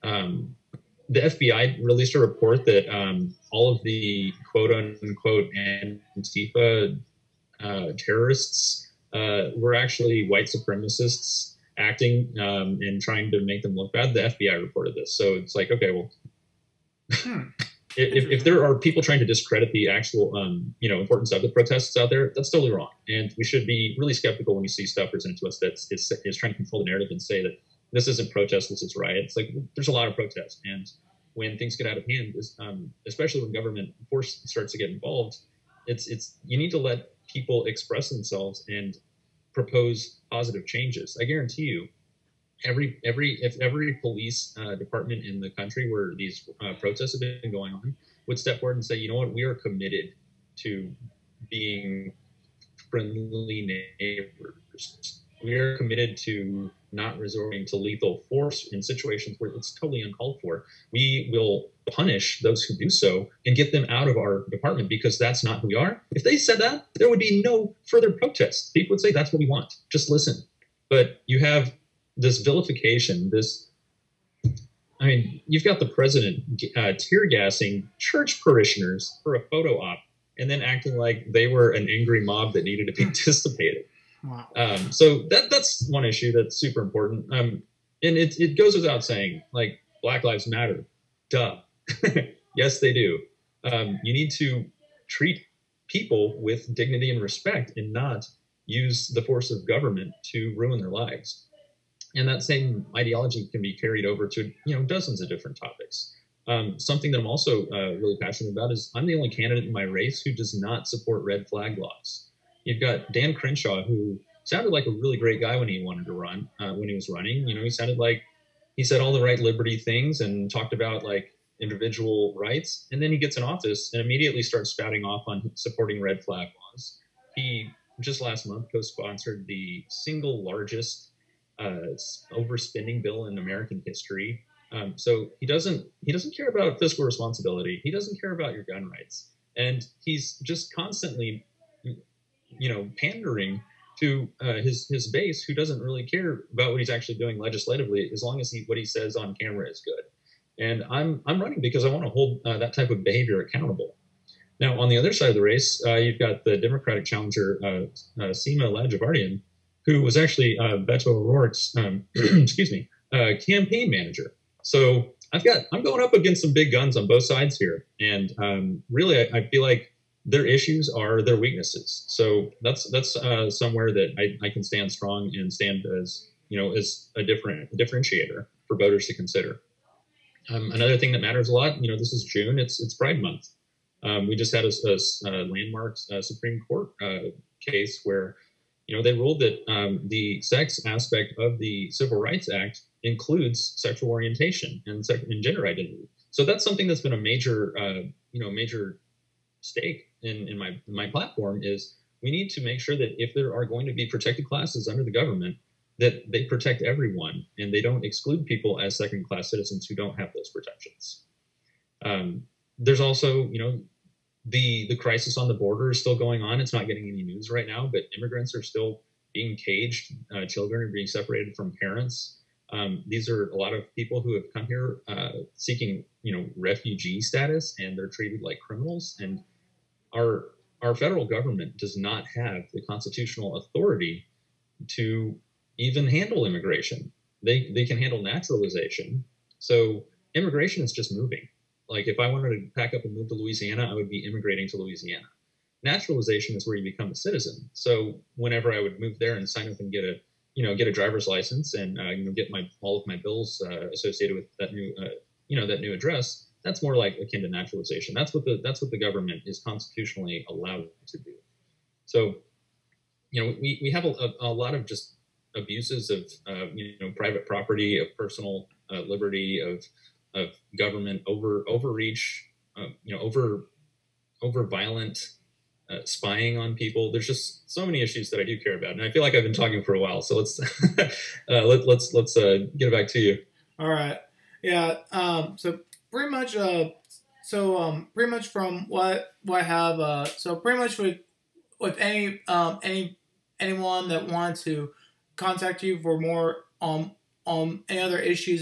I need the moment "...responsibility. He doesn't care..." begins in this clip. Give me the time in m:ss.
2:17.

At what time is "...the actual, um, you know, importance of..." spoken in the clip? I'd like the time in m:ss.
0:19.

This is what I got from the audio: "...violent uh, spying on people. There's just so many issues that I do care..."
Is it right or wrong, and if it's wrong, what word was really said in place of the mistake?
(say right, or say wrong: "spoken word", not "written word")
right.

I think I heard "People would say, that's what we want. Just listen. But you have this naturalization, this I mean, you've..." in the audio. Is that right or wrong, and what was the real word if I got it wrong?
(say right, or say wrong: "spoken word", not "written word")
wrong: "vilification", not "naturalization".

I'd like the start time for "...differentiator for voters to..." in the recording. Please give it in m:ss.
2:57.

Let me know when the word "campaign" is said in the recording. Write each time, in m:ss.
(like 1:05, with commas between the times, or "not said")
2:43.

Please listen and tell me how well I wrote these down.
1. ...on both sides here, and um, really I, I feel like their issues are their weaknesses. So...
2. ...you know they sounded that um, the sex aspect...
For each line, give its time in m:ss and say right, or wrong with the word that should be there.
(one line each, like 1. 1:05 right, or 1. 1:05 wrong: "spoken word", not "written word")
1. 2:46 right
2. 3:08 wrong: "ruled", not "sounded".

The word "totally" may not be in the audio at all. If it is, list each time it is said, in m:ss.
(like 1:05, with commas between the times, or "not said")
0:22, 0:59.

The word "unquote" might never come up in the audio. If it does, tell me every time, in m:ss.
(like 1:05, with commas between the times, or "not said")
0:04.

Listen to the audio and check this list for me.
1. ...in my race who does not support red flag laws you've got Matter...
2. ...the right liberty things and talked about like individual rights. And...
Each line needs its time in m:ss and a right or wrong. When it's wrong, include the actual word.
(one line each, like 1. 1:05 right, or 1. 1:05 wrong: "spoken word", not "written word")
1. 1:49 wrong: "Dan", not "Matter"
2. 1:59 right.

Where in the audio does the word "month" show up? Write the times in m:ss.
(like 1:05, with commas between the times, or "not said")
2:08, 3:03.